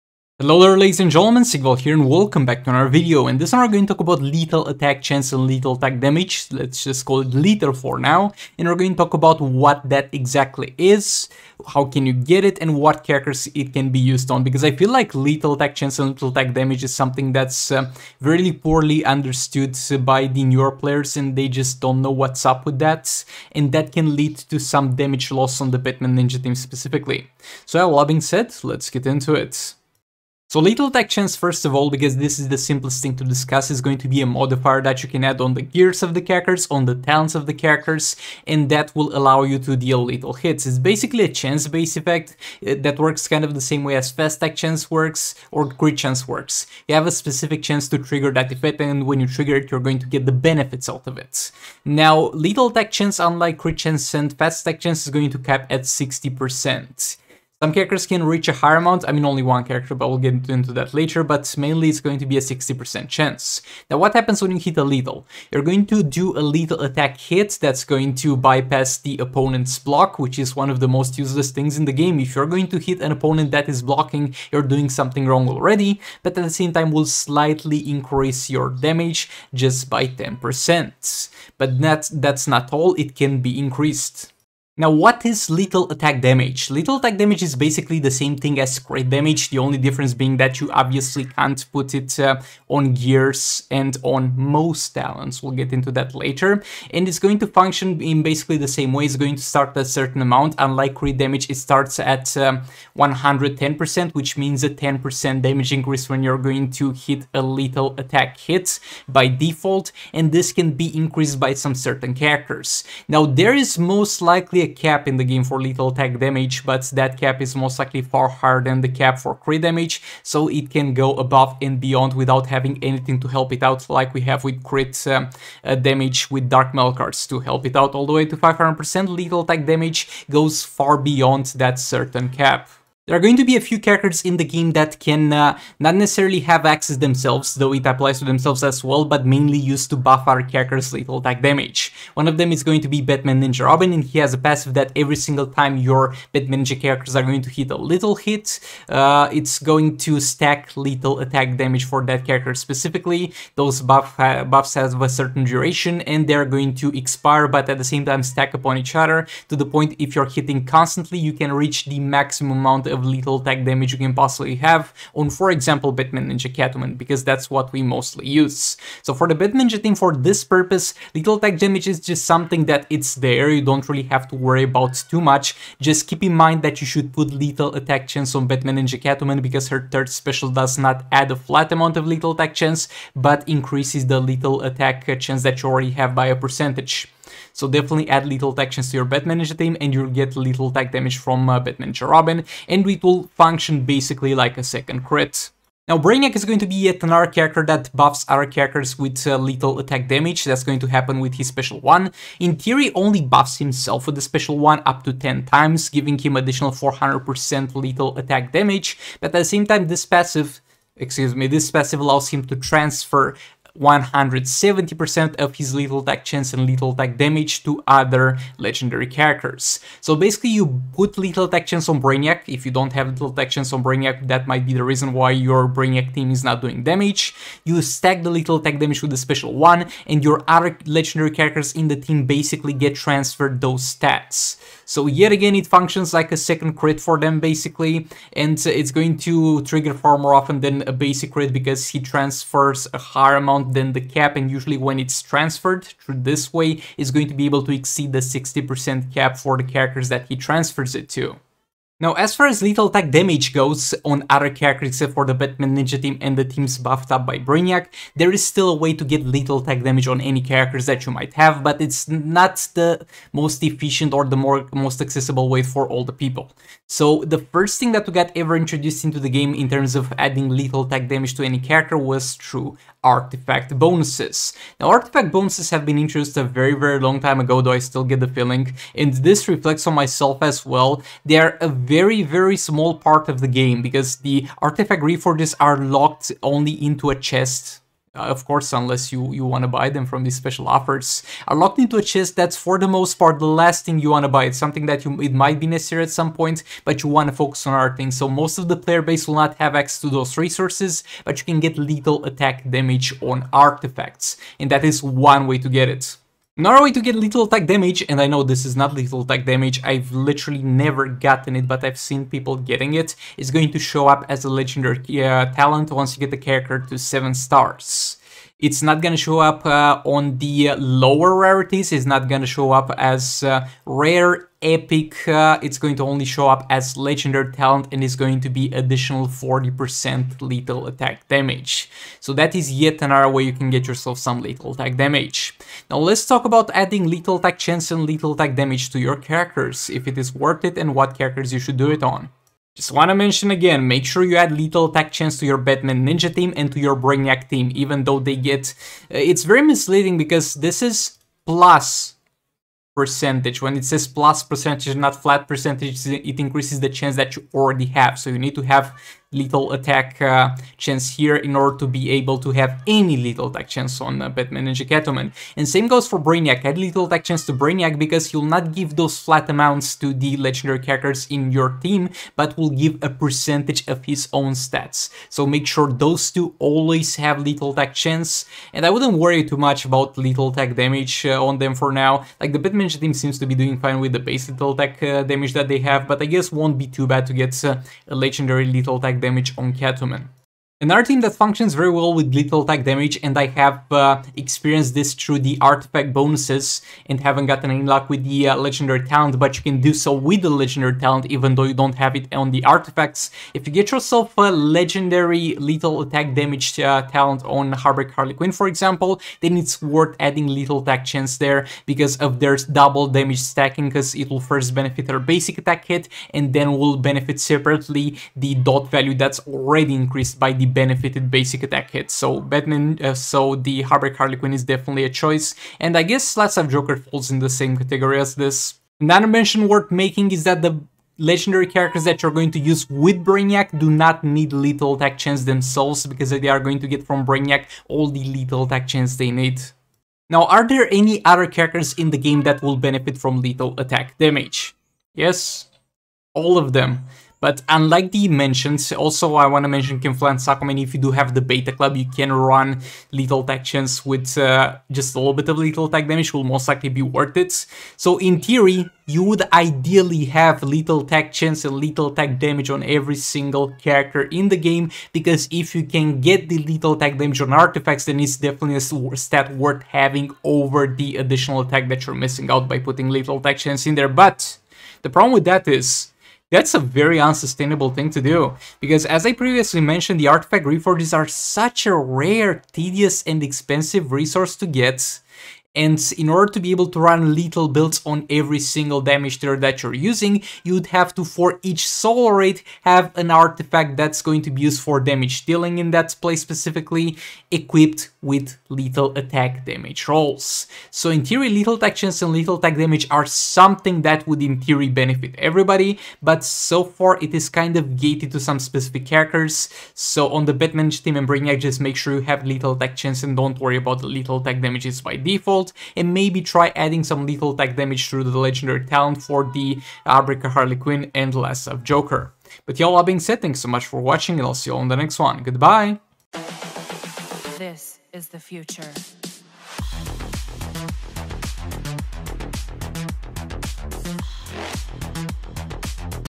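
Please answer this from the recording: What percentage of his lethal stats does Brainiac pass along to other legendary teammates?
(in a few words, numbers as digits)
170%.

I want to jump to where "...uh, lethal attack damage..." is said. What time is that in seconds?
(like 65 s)
199 s.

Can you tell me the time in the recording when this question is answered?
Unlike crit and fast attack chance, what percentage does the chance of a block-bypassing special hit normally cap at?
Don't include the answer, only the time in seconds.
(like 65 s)
55 s.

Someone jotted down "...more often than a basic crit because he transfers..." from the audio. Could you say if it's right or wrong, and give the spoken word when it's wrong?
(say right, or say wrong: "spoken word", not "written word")
right.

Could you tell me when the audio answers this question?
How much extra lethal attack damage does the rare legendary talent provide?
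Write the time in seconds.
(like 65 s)
329 s.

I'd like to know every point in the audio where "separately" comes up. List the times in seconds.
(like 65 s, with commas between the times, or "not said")
417 s.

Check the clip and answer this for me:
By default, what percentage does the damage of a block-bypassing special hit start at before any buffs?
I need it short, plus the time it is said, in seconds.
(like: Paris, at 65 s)
110%, at 102 s.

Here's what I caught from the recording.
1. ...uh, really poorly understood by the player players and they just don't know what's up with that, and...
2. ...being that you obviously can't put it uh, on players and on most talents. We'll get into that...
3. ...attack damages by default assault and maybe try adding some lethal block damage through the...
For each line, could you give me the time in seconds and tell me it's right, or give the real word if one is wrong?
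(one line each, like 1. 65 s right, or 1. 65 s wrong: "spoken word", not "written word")
1. 17 s wrong: "newer", not "player"
2. 90 s wrong: "gears", not "players"
3. 514 s wrong: "attack", not "block".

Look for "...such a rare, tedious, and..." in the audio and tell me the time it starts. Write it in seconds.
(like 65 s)
481 s.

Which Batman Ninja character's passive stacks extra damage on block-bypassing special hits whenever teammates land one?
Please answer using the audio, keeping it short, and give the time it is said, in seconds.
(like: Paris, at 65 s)
Batman Ninja Robin, at 143 s.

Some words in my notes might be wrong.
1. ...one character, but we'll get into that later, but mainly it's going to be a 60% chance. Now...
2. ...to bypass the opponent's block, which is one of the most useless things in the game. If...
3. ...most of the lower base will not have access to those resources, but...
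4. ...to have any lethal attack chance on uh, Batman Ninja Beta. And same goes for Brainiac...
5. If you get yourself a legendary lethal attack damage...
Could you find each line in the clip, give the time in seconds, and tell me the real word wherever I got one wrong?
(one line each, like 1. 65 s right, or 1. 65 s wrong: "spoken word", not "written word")
1. 59 s right
2. 68 s right
3. 298 s wrong: "player", not "lower"
4. 362 s wrong: "Catwoman", not "Beta"
5. 403 s right.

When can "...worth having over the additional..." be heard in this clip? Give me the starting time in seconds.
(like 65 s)
469 s.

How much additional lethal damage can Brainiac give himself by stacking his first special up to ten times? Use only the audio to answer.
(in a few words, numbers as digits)
400%.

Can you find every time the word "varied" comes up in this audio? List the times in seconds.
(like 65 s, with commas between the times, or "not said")
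not said.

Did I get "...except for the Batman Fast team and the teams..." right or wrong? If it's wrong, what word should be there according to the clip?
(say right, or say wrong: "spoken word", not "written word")
wrong: "Ninja", not "Fast".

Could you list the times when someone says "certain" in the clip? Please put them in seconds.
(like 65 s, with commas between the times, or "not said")
99 s, 111 s, 131 s, 155 s.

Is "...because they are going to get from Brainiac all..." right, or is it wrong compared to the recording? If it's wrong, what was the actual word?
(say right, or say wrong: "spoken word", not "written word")
right.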